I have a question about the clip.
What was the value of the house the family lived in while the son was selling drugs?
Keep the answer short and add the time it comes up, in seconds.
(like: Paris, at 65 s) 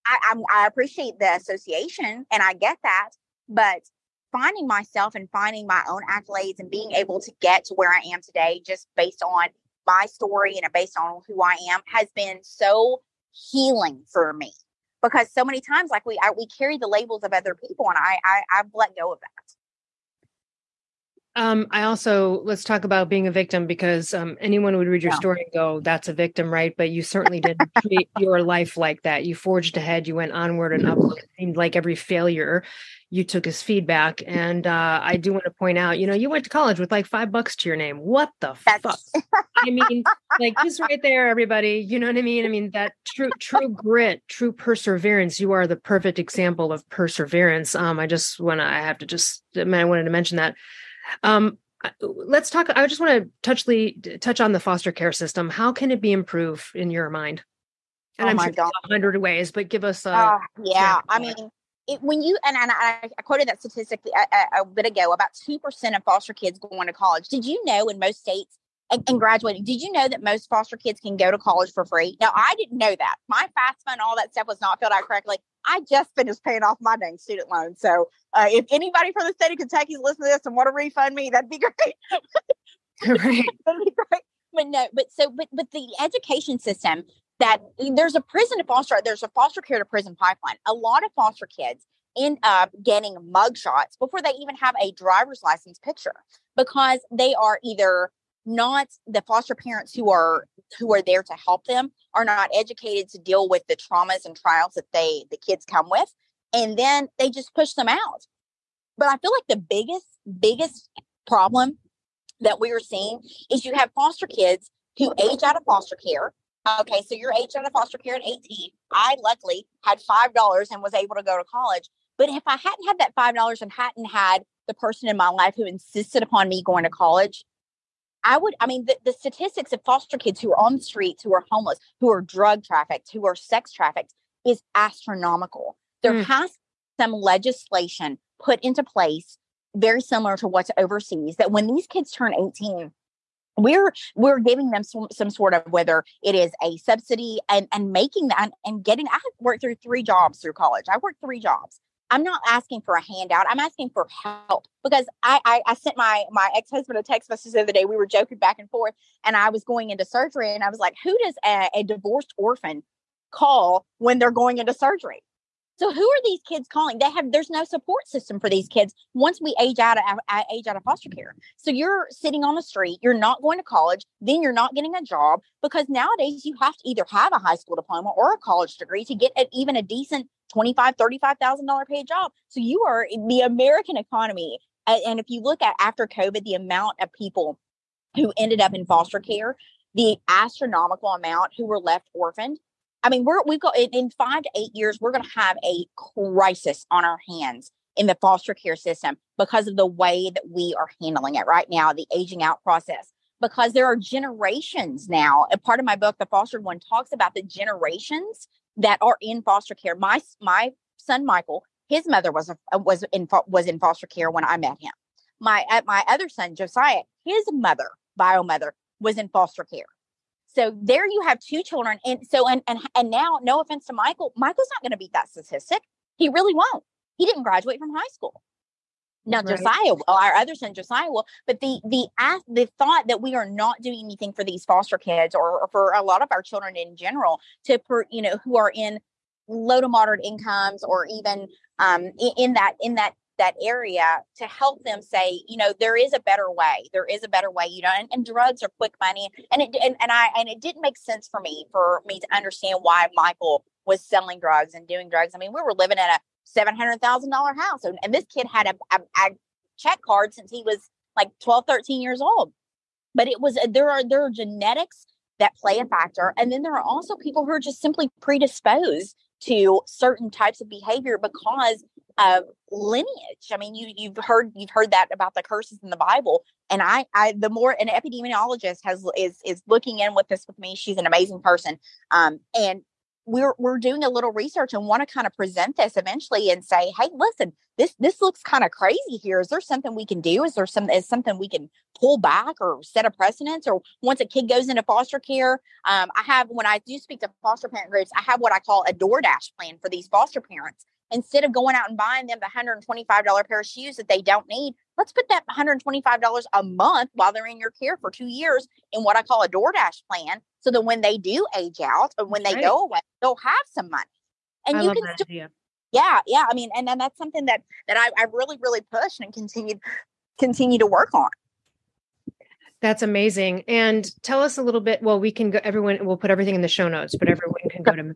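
$700,000, at 256 s.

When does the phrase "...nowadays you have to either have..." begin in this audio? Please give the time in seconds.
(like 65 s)
175 s.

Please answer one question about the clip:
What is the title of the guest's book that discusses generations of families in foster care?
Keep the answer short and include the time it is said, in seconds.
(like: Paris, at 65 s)
The Fostered One, at 206 s.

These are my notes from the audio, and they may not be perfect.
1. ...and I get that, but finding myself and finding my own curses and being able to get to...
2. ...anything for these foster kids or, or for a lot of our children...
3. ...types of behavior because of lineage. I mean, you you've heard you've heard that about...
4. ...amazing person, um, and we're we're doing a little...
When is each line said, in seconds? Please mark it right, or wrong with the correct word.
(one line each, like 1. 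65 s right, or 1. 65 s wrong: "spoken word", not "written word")
1. 2 s wrong: "accolades", not "curses"
2. 234 s right
3. 270 s right
4. 281 s right.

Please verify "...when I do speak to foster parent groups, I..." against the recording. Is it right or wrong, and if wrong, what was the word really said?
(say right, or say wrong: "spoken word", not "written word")
right.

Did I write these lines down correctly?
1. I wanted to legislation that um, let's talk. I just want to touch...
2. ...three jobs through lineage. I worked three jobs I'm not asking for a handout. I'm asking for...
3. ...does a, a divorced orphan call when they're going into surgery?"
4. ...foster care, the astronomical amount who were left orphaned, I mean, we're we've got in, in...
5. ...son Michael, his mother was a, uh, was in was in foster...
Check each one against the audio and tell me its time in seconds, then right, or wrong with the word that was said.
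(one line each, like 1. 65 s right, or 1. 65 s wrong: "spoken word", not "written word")
1. 49 s wrong: "mention", not "legislation"
2. 149 s wrong: "college", not "lineage"
3. 161 s right
4. 188 s right
5. 210 s right.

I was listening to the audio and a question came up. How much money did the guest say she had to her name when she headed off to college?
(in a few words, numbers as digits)
$5.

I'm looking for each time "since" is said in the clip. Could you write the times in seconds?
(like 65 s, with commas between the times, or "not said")
260 s.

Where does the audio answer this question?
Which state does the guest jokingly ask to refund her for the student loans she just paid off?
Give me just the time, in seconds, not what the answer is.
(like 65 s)
79 s.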